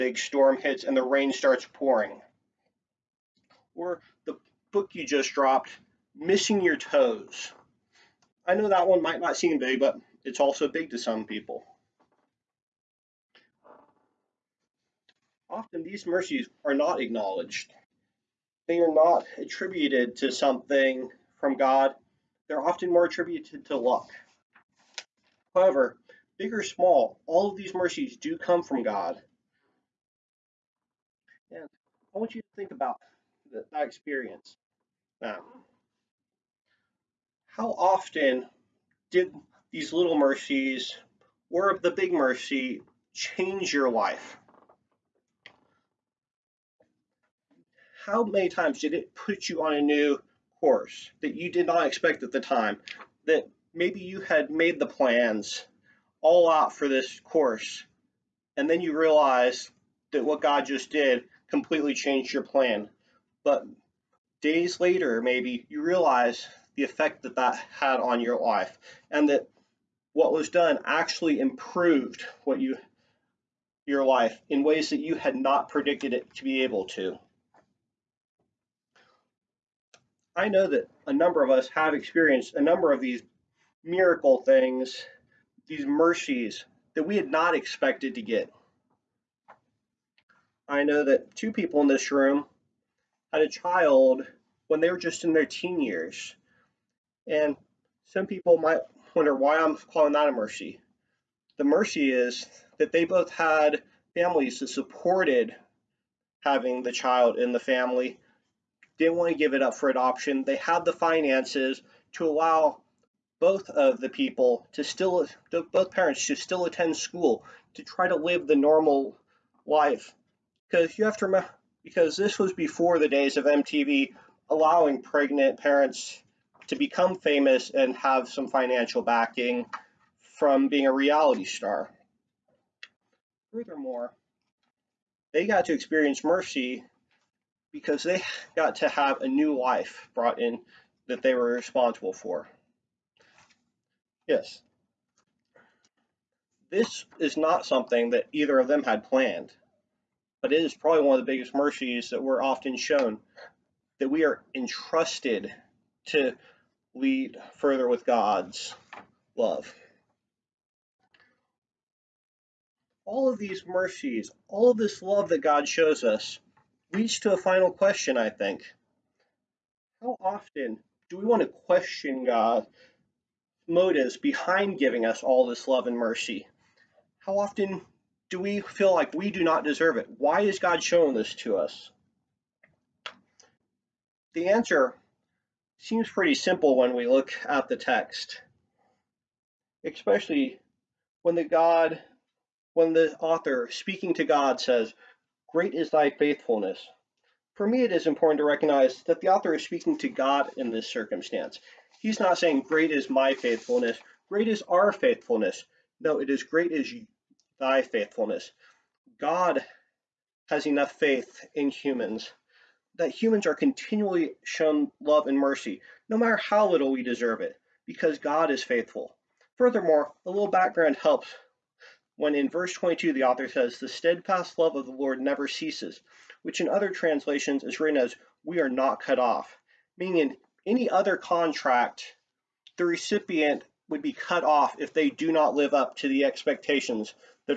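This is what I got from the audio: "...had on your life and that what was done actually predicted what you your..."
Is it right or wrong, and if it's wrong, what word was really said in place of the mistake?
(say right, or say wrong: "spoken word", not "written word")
wrong: "improved", not "predicted".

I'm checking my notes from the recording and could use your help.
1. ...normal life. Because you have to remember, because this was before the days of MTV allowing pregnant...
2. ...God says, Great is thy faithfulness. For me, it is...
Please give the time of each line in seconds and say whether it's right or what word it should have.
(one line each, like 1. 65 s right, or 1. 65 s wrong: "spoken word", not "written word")
1. 118 s right
2. 194 s right.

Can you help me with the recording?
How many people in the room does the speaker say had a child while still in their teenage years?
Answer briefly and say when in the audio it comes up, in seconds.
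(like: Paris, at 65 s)
2, at 91 s.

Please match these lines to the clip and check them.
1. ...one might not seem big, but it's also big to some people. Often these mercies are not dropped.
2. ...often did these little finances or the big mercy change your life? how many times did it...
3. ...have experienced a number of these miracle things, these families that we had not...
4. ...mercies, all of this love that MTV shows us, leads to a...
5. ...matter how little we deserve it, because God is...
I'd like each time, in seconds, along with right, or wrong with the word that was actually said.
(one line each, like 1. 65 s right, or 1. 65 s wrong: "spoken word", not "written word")
1. 8 s wrong: "acknowledged", not "dropped"
2. 37 s wrong: "mercies", not "finances"
3. 81 s wrong: "mercies", not "families"
4. 163 s wrong: "God", not "MTV"
5. 216 s right.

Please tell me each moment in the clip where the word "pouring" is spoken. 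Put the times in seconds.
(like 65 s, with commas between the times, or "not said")
1 s.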